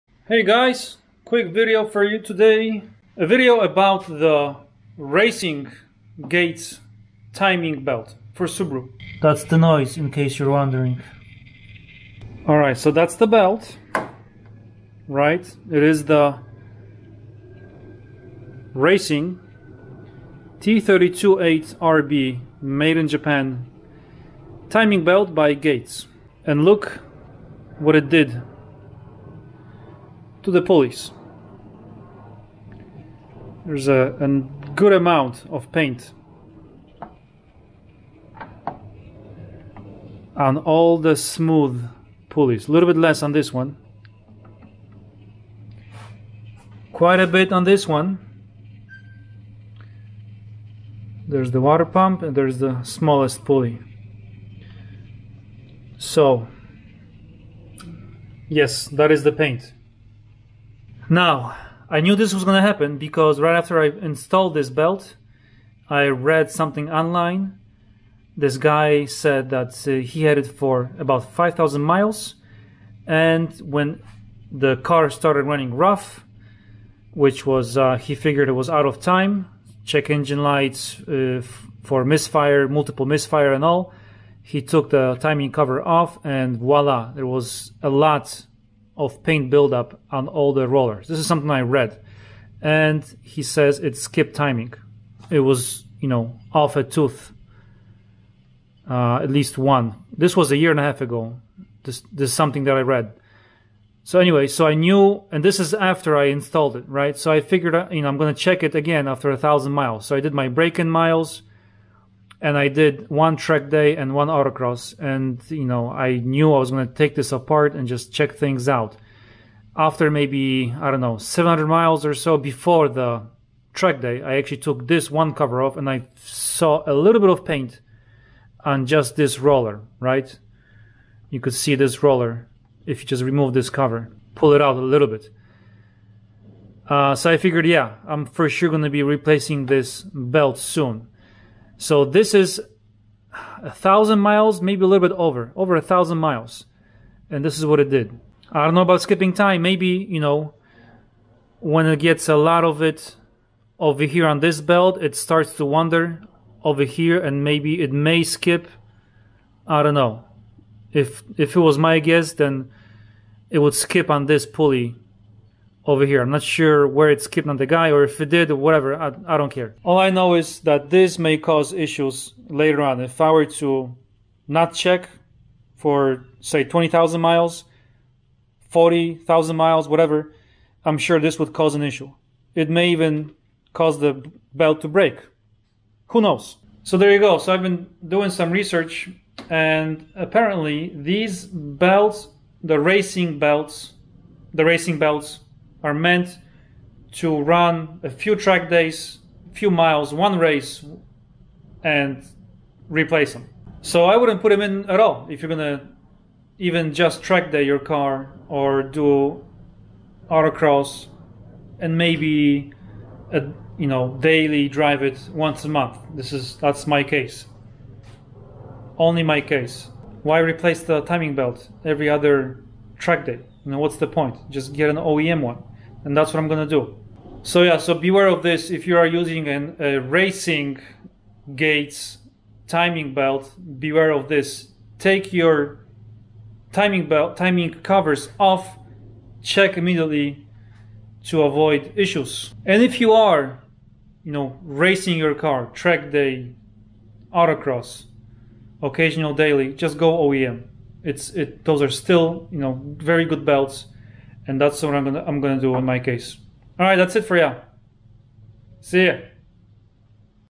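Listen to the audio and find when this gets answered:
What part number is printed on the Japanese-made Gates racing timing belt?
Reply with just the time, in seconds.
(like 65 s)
20 s.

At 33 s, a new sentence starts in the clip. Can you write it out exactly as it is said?
There's a, a good amount of paint on all the smooth pulleys.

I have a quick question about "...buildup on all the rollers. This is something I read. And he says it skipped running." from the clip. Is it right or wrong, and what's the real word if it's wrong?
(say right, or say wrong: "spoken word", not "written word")
wrong: "timing", not "running".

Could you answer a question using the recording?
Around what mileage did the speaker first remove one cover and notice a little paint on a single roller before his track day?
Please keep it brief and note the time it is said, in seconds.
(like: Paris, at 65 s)
700, at 121 s.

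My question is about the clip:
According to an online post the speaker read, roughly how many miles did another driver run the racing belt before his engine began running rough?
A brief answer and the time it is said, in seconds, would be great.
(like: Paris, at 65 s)
5,000 miles, at 71 s.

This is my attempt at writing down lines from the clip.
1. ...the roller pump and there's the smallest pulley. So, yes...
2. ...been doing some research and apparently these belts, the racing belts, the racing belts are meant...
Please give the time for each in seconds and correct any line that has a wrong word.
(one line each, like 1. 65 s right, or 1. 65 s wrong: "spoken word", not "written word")
1. 51 s wrong: "water", not "roller"
2. 187 s right.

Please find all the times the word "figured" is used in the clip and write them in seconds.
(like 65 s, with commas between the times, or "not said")
78 s, 107 s, 137 s.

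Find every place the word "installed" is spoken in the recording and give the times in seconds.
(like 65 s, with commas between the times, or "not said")
63 s, 106 s.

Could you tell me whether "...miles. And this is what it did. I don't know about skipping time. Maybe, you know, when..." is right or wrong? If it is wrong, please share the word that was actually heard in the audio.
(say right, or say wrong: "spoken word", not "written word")
right.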